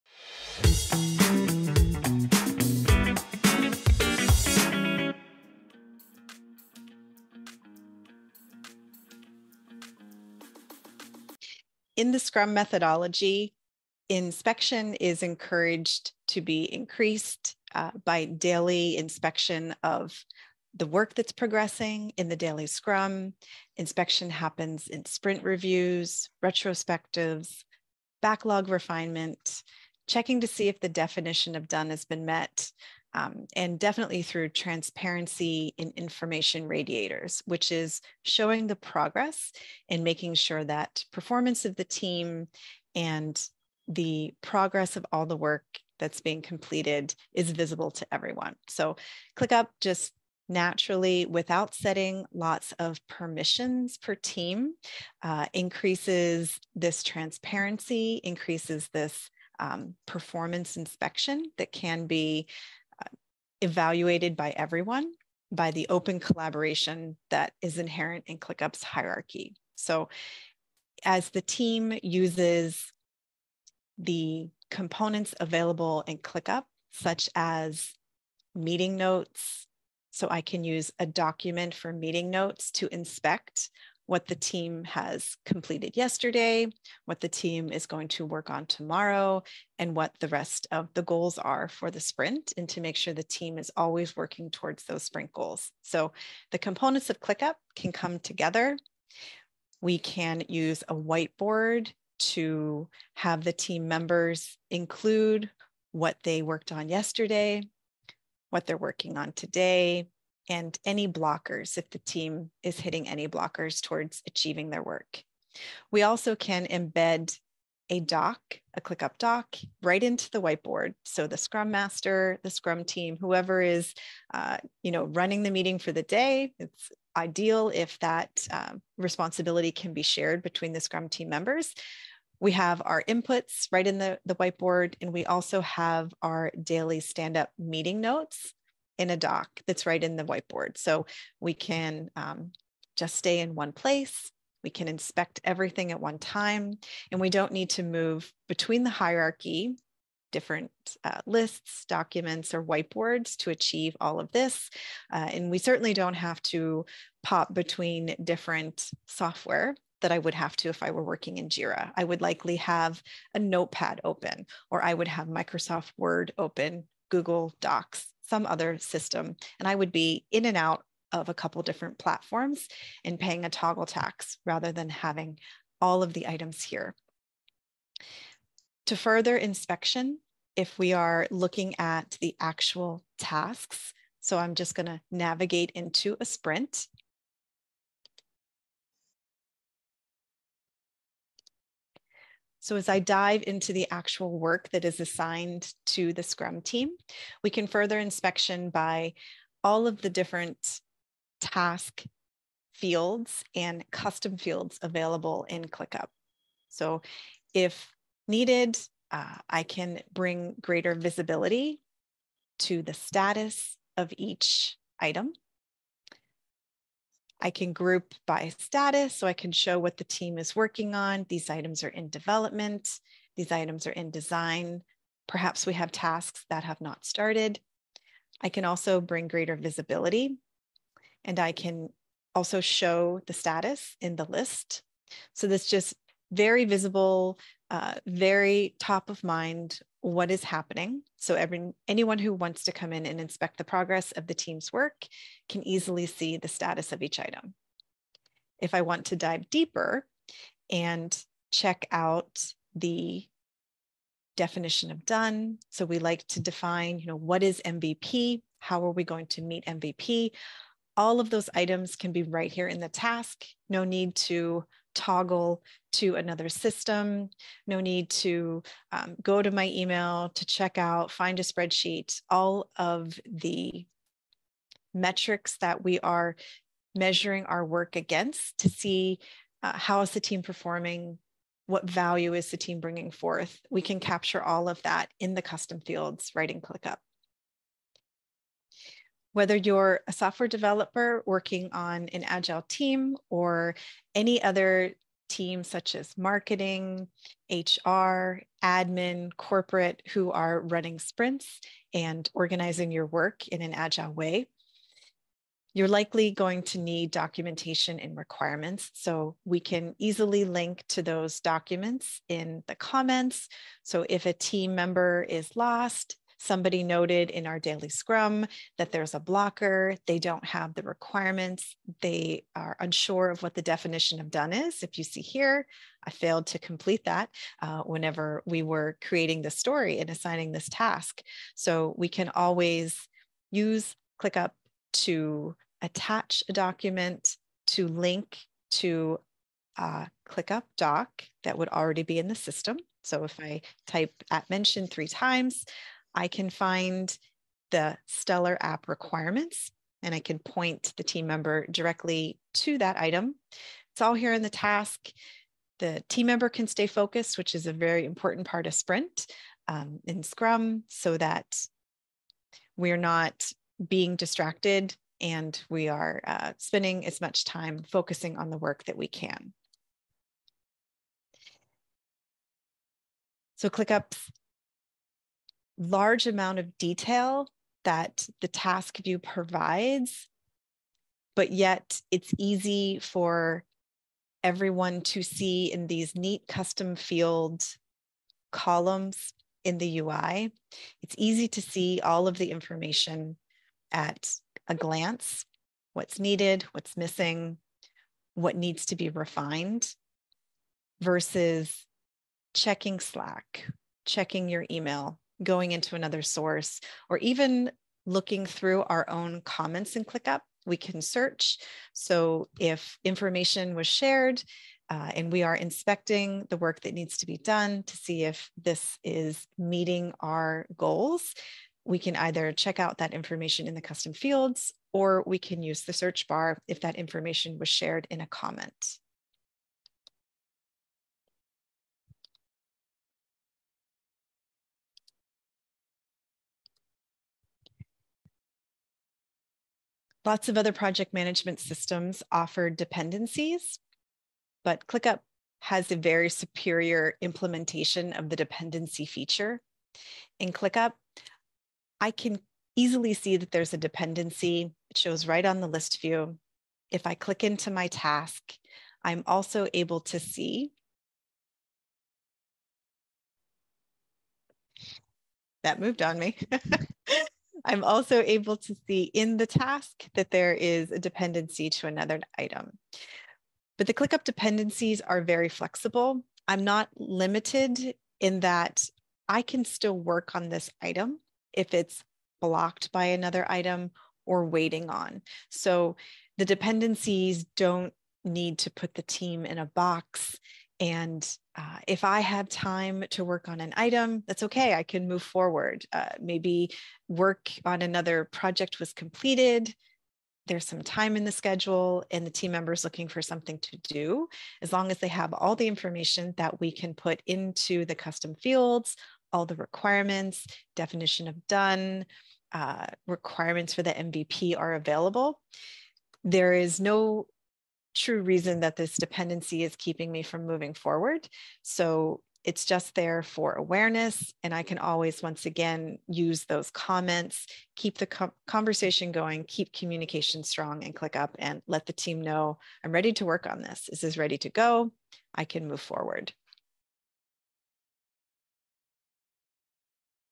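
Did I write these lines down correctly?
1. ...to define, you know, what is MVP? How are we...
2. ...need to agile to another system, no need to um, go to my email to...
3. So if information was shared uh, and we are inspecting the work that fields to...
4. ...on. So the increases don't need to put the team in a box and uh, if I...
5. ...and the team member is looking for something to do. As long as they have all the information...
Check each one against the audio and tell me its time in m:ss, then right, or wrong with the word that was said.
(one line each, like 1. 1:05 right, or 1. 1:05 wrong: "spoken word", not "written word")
1. 4:16 right
2. 4:23 wrong: "toggle", not "agile"
3. 6:51 wrong: "needs", not "fields"
4. 8:04 wrong: "dependencies", not "increases"
5. 8:22 right.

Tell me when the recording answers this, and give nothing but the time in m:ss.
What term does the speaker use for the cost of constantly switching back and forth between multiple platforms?
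2:53.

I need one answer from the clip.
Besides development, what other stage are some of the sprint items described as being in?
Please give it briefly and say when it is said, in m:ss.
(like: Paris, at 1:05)
design, at 3:44.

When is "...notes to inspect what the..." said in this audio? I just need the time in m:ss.
1:22.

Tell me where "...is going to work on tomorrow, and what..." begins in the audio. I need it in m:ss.
1:27.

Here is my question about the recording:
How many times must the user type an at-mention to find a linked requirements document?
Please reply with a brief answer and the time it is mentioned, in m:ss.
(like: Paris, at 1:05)
3, at 5:44.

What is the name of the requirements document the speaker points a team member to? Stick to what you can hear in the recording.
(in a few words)
Stellar app requirements.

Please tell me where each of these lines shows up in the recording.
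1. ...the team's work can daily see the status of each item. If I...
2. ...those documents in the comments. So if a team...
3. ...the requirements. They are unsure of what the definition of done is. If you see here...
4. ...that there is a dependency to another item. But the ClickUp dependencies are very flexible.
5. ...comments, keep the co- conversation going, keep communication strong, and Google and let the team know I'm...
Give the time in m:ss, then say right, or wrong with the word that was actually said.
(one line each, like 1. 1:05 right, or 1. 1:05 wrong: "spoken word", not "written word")
1. 4:04 wrong: "easily", not "daily"
2. 5:11 right
3. 5:20 right
4. 7:50 right
5. 8:46 wrong: "ClickUp", not "Google".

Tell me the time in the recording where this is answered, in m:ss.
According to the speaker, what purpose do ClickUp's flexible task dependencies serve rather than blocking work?
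8:43.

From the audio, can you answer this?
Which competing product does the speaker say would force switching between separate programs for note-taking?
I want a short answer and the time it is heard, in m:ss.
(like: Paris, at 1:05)
JIRA, at 2:41.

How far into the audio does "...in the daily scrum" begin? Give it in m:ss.
0:22.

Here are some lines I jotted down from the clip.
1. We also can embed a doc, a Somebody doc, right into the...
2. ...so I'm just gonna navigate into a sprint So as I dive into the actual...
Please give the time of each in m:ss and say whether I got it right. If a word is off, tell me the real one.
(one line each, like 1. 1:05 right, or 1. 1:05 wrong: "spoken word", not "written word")
1. 1:55 wrong: "ClickUp", not "Somebody"
2. 3:04 right.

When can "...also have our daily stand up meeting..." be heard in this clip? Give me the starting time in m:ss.
2:15.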